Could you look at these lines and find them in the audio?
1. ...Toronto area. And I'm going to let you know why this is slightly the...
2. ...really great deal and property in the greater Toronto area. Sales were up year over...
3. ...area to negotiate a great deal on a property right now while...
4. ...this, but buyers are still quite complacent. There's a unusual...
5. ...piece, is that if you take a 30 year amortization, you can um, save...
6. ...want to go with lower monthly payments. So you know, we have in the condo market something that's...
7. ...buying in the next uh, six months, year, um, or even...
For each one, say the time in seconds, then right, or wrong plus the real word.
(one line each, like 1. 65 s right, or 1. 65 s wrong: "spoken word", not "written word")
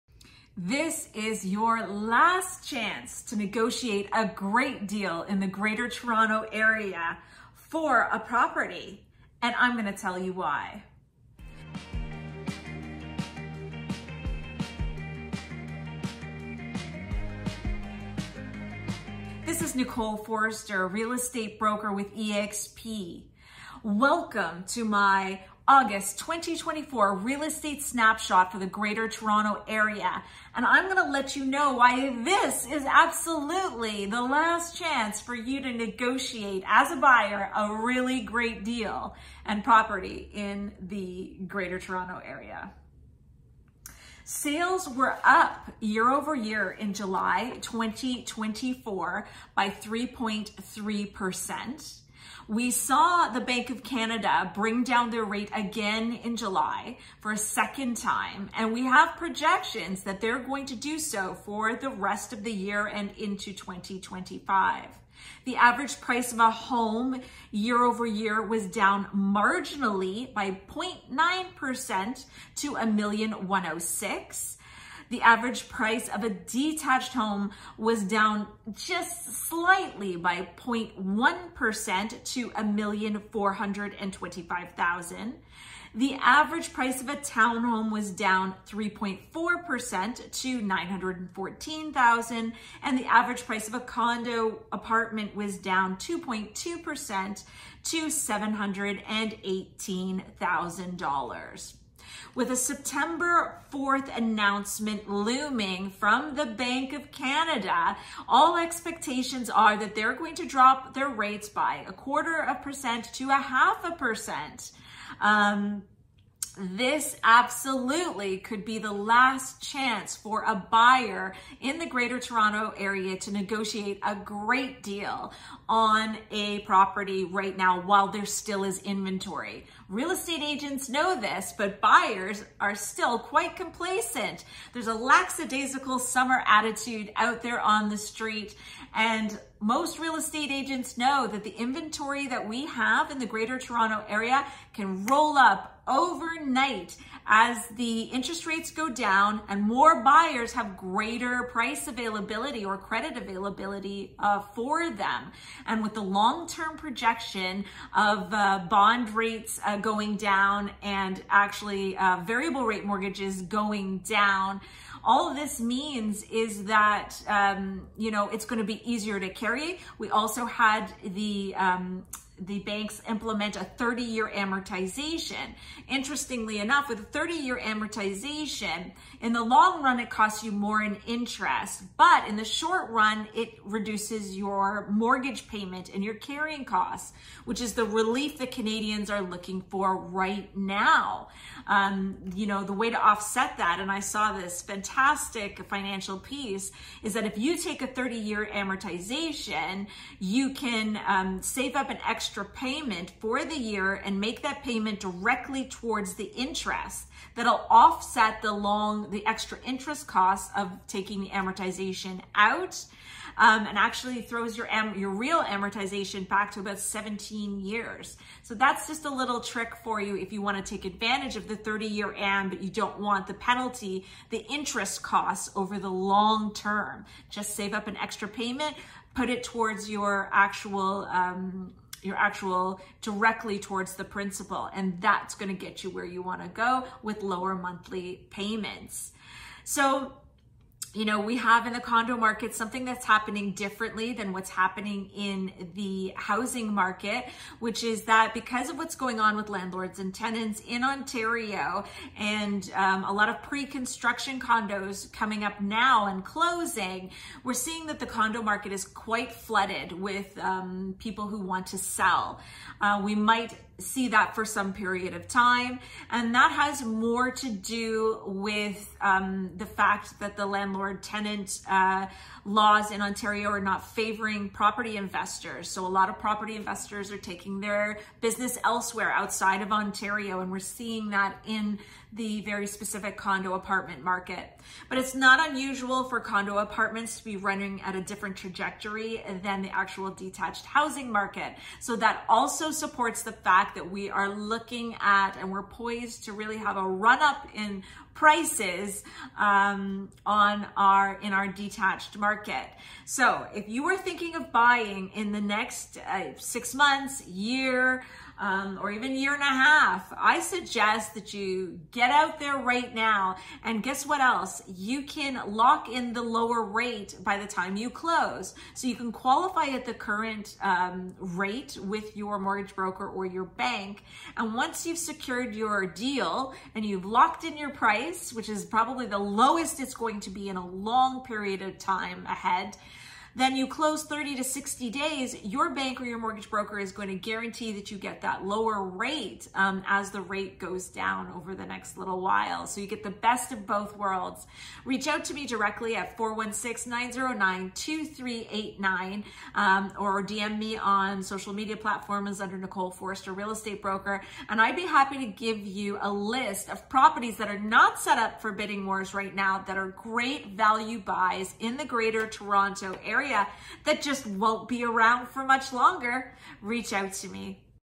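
1. 29 s wrong: "absolutely", not "slightly"
2. 37 s right
3. 122 s right
4. 131 s wrong: "lackadaisical", not "unusual"
5. 196 s right
6. 236 s right
7. 304 s right.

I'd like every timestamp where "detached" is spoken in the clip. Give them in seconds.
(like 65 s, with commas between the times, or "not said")
76 s, 290 s, 301 s.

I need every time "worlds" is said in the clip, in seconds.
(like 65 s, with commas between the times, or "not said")
343 s.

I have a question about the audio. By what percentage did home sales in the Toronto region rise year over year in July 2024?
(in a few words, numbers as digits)
3.3%.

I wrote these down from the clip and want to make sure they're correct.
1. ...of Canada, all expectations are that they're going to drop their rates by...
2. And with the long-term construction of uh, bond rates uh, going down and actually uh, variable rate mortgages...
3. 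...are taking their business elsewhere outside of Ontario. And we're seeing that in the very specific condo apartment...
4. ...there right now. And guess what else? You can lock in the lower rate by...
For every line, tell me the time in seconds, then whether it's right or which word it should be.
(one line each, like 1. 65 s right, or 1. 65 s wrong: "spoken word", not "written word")
1. 106 s right
2. 155 s wrong: "projection", not "construction"
3. 277 s right
4. 312 s right.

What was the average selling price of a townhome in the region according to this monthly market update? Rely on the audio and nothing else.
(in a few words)
$914,000.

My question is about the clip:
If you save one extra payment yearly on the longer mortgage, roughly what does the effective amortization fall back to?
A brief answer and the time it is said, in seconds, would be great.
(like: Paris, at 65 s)
17 years, at 216 s.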